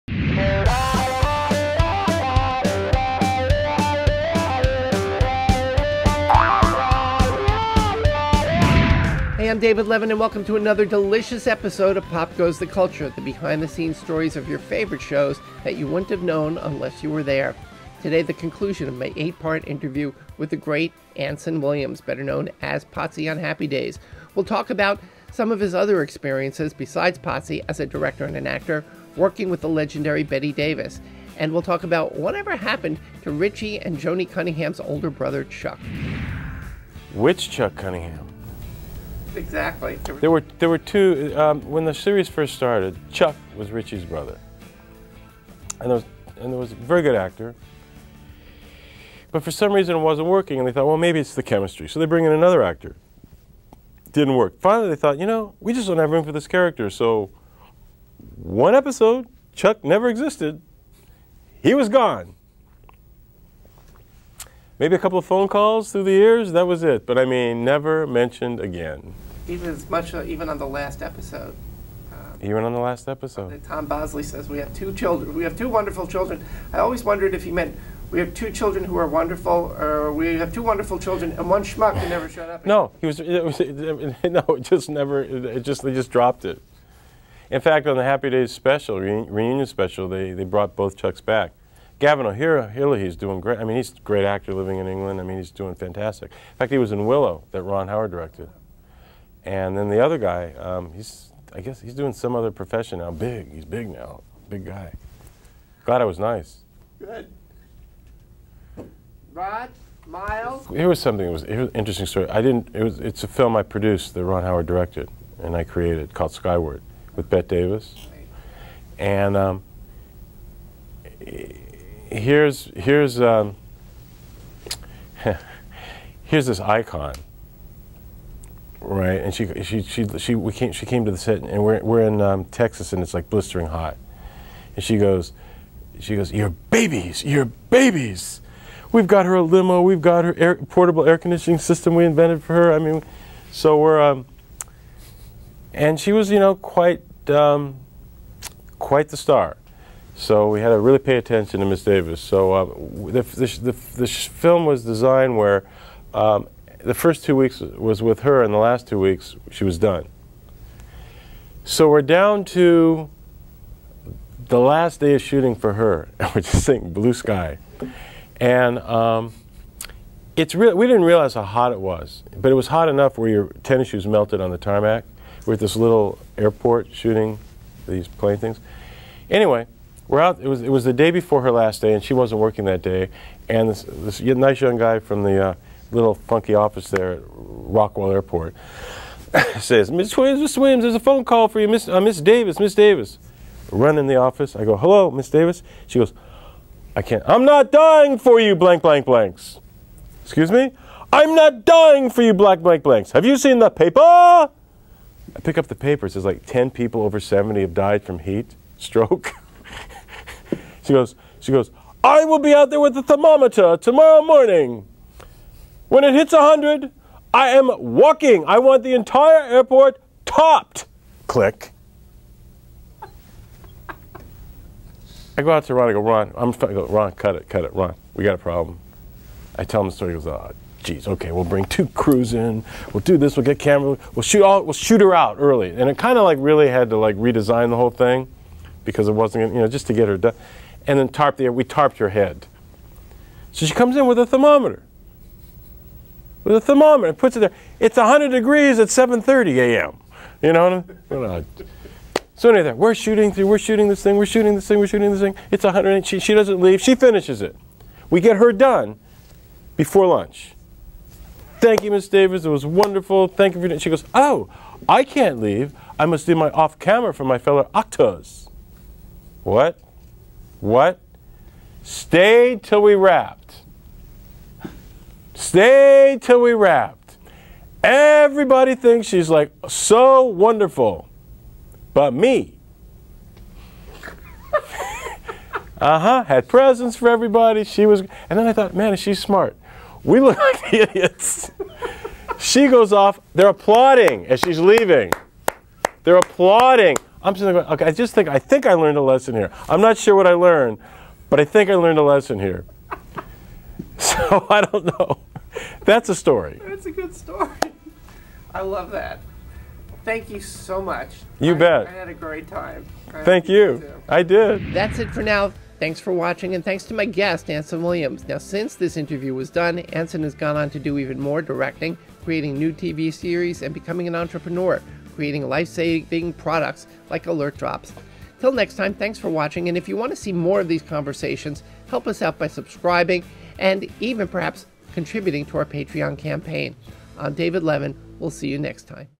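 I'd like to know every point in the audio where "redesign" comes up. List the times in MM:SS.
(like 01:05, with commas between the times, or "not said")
03:57.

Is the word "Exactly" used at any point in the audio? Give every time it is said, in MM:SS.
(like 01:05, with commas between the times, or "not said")
00:39.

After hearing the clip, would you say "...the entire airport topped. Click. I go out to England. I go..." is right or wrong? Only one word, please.
wrong.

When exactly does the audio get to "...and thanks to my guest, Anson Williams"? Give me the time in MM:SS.
05:16.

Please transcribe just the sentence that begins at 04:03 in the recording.
So she comes in with a thermometer.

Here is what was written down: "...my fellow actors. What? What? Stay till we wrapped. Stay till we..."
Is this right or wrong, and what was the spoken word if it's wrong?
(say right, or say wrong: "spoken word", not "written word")
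right.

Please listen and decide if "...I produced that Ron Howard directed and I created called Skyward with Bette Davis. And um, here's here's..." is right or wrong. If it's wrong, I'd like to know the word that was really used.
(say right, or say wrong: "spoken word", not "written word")
right.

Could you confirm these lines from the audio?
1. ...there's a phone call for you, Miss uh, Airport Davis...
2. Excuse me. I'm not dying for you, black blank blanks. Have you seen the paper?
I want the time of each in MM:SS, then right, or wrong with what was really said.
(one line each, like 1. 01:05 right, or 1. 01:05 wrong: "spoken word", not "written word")
1. 03:10 wrong: "Miss", not "Airport"
2. 03:20 right.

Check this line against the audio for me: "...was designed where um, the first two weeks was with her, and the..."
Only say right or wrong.
right.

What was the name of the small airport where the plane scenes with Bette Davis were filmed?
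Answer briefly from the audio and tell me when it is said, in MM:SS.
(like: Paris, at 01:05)
Rockwell Airport, at 03:07.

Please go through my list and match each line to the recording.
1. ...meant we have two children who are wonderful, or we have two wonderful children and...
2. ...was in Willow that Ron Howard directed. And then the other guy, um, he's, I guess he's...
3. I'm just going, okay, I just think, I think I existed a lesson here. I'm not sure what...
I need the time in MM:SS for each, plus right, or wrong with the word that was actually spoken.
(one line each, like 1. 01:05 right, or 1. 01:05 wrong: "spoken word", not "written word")
1. 01:17 right
2. 01:36 right
3. 04:57 wrong: "learned", not "existed".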